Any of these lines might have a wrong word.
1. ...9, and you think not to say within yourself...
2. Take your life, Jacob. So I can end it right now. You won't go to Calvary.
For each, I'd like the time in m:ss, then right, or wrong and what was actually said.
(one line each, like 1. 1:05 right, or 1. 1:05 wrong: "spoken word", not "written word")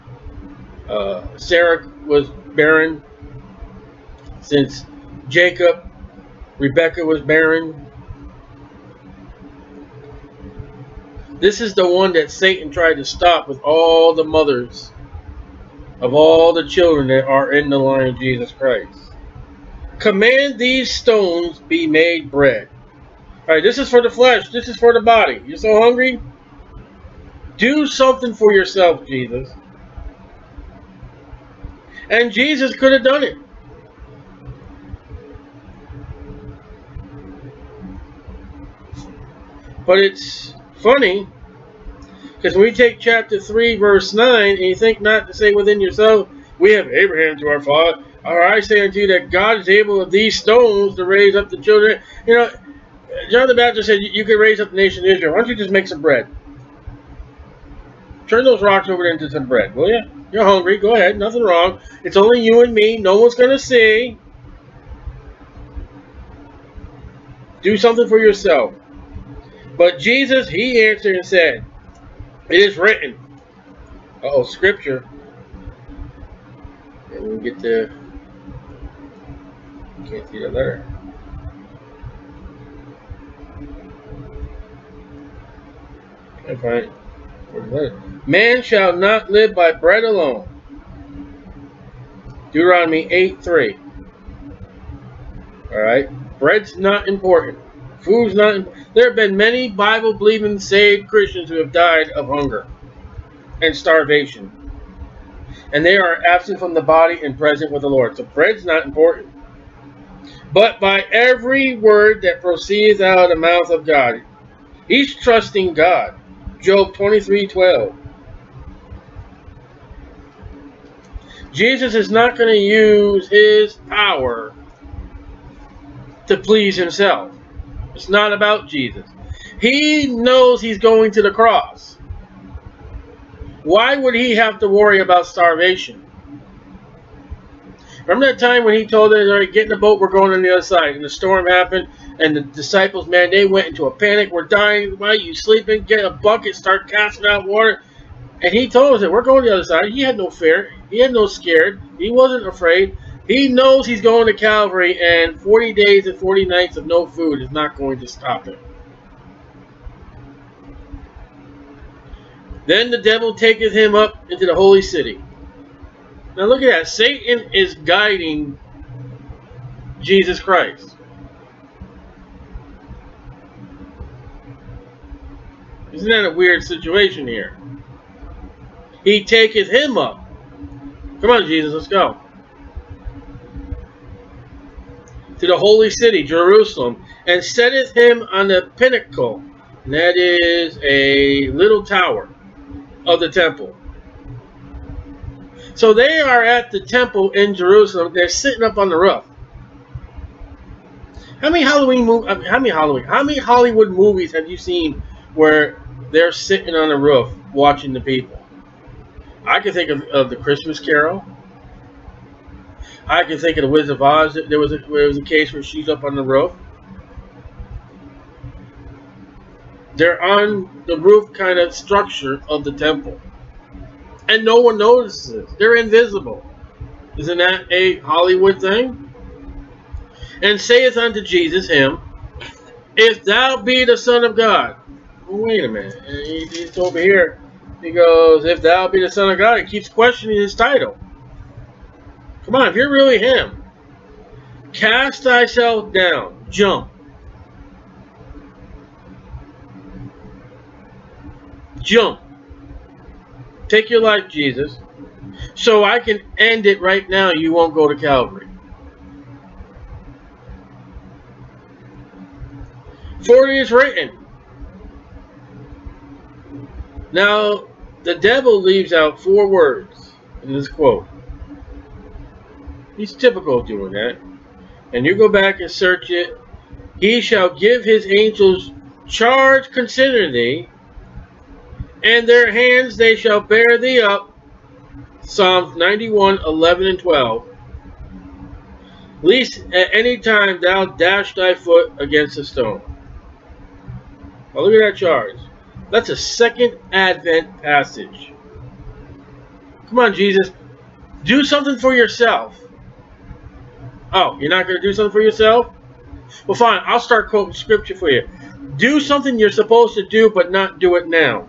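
1. 0:44 right
2. 4:13 wrong: "Jesus", not "Jacob".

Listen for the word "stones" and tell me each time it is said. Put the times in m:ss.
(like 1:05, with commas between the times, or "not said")
0:20, 0:50, 4:52.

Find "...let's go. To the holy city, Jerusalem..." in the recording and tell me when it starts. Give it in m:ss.
3:01.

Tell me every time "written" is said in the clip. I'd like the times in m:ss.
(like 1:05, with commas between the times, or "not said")
1:12, 4:23.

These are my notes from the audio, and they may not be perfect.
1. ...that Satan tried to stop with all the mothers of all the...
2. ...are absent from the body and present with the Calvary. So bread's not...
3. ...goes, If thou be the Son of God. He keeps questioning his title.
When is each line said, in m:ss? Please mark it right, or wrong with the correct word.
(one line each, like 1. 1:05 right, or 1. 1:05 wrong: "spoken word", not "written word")
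1. 0:12 right
2. 1:45 wrong: "Lord", not "Calvary"
3. 3:57 right.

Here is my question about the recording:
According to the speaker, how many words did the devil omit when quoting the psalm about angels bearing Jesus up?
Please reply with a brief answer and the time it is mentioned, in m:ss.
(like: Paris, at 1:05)
4, at 4:29.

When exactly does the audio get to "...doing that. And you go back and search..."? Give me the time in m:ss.
4:33.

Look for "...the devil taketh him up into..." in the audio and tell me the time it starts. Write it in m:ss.
2:42.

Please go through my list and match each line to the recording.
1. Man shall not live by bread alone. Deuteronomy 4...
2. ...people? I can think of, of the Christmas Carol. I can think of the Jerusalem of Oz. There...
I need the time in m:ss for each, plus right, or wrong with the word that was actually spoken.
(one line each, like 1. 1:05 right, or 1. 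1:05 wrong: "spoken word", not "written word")
1. 1:28 wrong: "8", not "4"
2. 3:28 wrong: "Wizard", not "Jerusalem".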